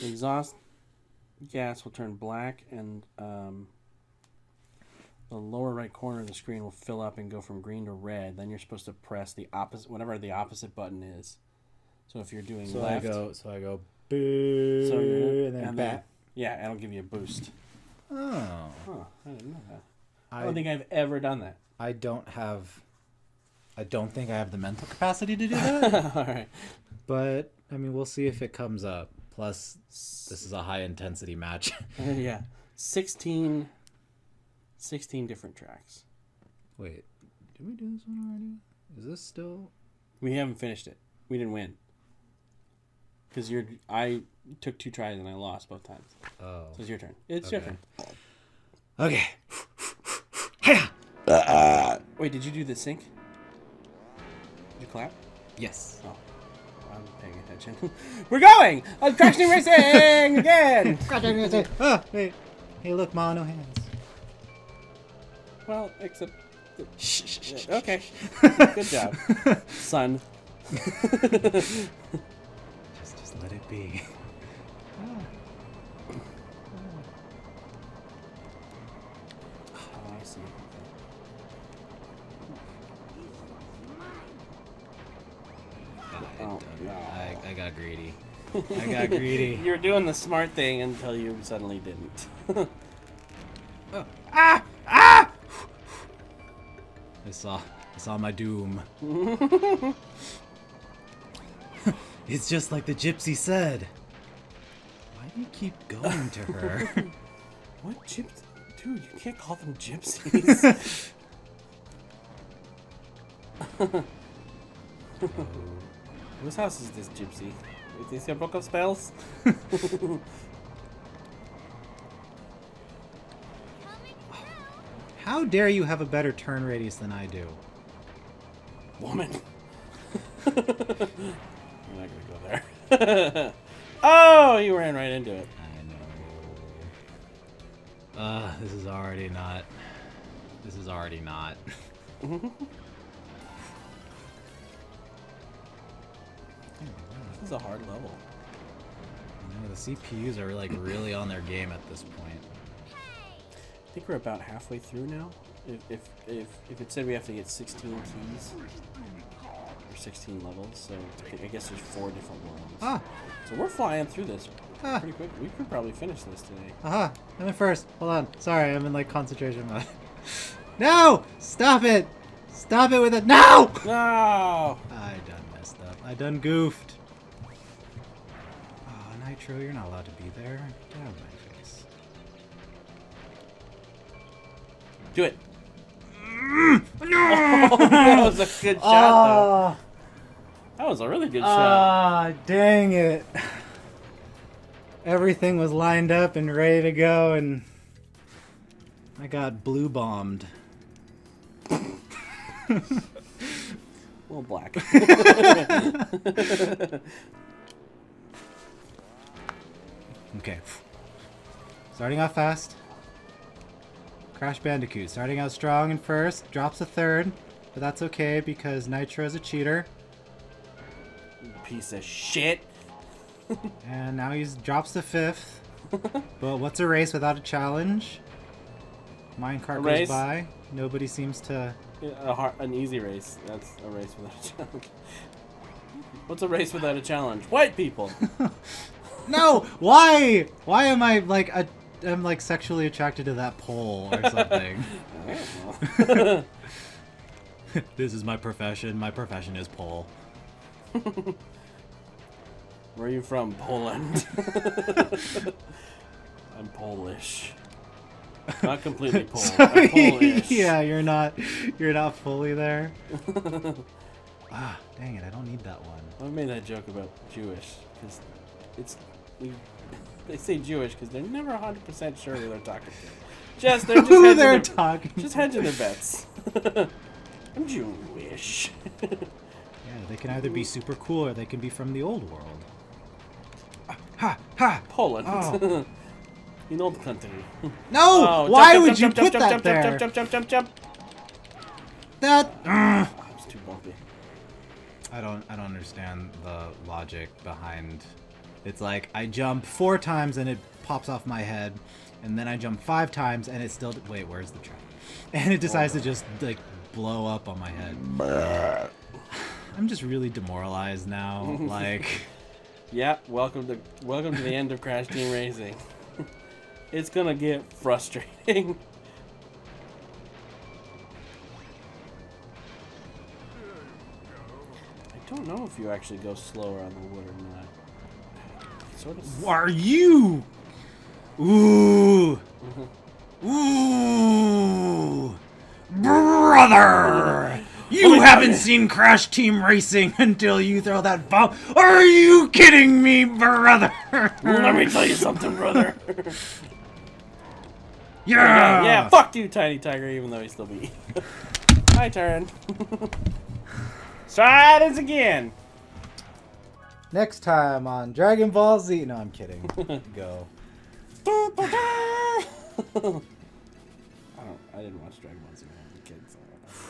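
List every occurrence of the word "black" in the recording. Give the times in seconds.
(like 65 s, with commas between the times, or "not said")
2 s, 204 s.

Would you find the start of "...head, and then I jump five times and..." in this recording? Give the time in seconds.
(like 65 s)
301 s.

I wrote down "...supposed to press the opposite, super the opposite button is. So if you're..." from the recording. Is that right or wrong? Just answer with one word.
wrong.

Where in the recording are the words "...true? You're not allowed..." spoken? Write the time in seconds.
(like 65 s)
179 s.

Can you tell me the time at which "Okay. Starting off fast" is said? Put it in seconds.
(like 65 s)
210 s.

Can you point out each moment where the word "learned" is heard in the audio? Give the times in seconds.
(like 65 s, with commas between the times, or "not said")
not said.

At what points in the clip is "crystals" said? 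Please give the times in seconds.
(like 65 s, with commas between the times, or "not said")
not said.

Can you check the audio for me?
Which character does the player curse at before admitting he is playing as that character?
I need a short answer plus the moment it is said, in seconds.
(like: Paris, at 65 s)
Tiny Tiger, at 349 s.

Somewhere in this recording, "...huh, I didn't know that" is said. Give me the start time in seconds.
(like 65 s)
18 s.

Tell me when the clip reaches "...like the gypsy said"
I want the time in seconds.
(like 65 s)
102 s.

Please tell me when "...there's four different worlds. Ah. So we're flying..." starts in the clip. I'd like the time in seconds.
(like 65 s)
161 s.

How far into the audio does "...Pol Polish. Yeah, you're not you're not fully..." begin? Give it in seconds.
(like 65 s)
259 s.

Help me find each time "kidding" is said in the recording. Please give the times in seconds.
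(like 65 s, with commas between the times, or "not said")
342 s, 359 s.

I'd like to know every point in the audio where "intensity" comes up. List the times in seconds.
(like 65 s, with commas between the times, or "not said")
30 s.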